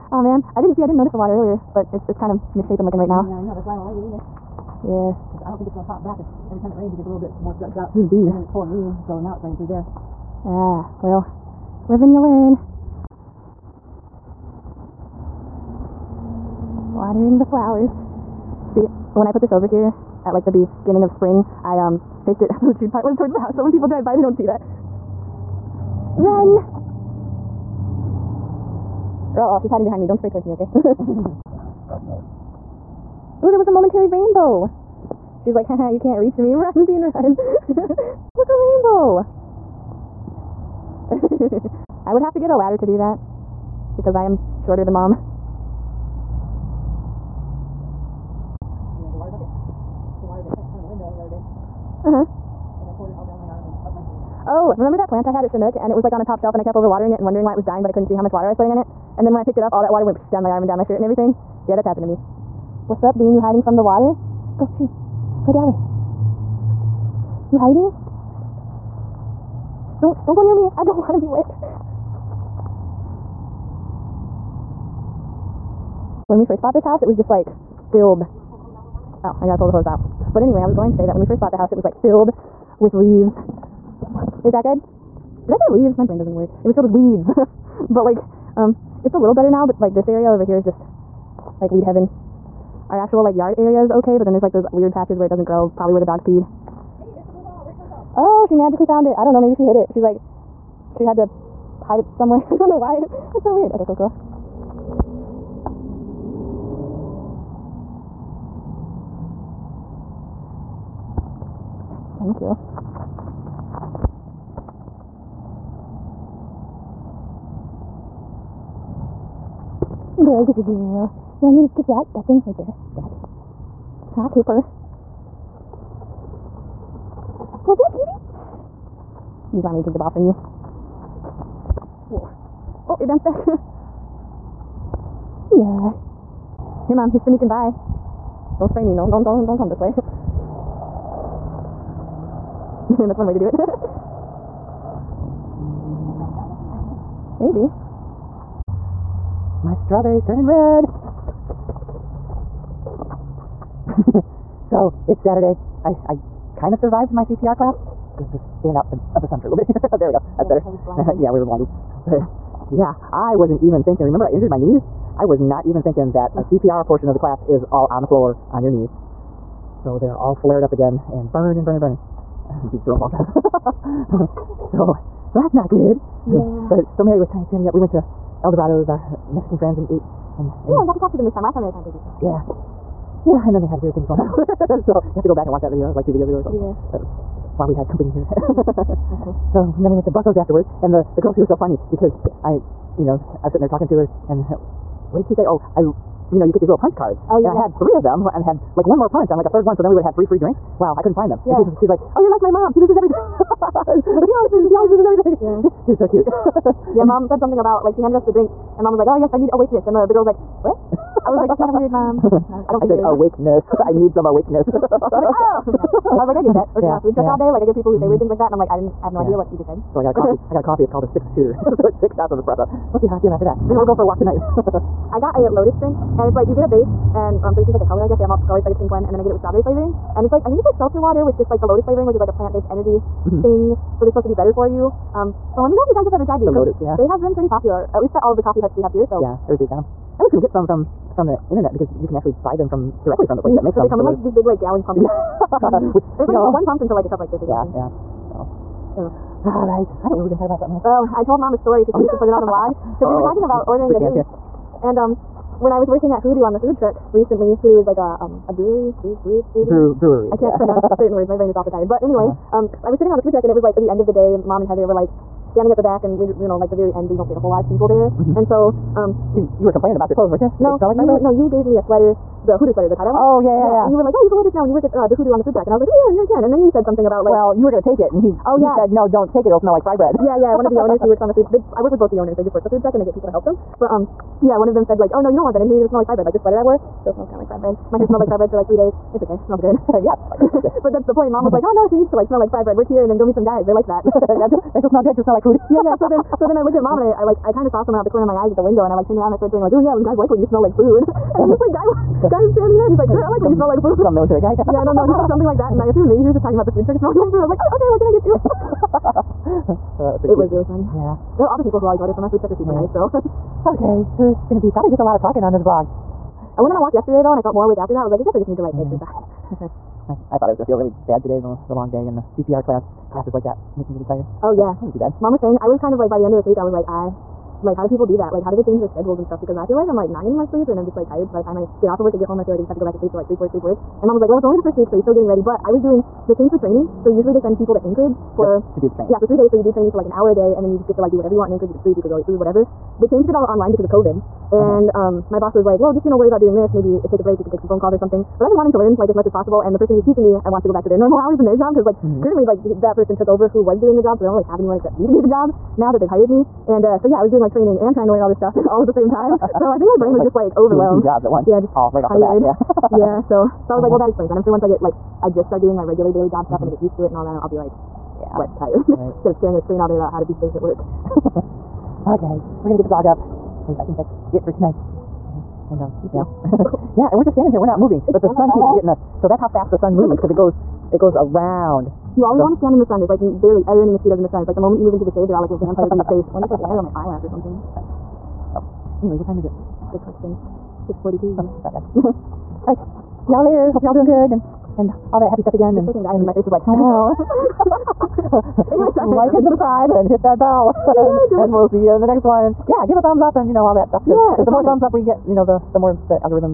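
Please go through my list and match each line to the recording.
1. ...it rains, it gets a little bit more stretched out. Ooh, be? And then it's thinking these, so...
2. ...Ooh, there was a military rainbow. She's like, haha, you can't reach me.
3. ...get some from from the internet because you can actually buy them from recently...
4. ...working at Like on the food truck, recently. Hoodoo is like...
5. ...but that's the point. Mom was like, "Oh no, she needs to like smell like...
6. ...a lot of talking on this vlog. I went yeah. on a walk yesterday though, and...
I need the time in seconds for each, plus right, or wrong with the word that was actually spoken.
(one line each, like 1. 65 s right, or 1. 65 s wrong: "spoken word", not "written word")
1. 6 s wrong: "pulling", not "thinking"
2. 33 s wrong: "momentary", not "military"
3. 240 s wrong: "directly", not "recently"
4. 255 s wrong: "Hoodoo", not "Like"
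5. 290 s right
6. 314 s right.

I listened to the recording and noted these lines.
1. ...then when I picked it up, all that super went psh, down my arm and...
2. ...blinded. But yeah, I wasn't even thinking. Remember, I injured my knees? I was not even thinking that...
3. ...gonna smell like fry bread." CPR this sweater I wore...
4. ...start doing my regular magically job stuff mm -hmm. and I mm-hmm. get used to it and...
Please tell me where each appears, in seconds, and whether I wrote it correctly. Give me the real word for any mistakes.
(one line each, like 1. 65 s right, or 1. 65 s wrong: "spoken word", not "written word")
1. 59 s wrong: "water", not "super"
2. 161 s right
3. 285 s wrong: "Like", not "CPR"
4. 365 s wrong: "daily", not "magically".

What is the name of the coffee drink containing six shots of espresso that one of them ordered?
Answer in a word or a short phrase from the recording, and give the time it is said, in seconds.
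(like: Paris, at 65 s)
six shooter, at 221 s.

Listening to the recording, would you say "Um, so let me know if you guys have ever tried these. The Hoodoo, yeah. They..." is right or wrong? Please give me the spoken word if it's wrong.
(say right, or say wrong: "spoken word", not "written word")
wrong: "Lotus", not "Hoodoo".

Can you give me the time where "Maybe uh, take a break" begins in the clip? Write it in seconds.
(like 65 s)
346 s.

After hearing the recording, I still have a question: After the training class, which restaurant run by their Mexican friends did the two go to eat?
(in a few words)
El Dorado's.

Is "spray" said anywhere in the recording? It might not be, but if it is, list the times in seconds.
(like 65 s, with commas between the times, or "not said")
30 s, 138 s.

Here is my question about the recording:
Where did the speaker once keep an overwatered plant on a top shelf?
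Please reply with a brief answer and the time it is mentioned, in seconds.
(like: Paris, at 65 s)
Chinook, at 55 s.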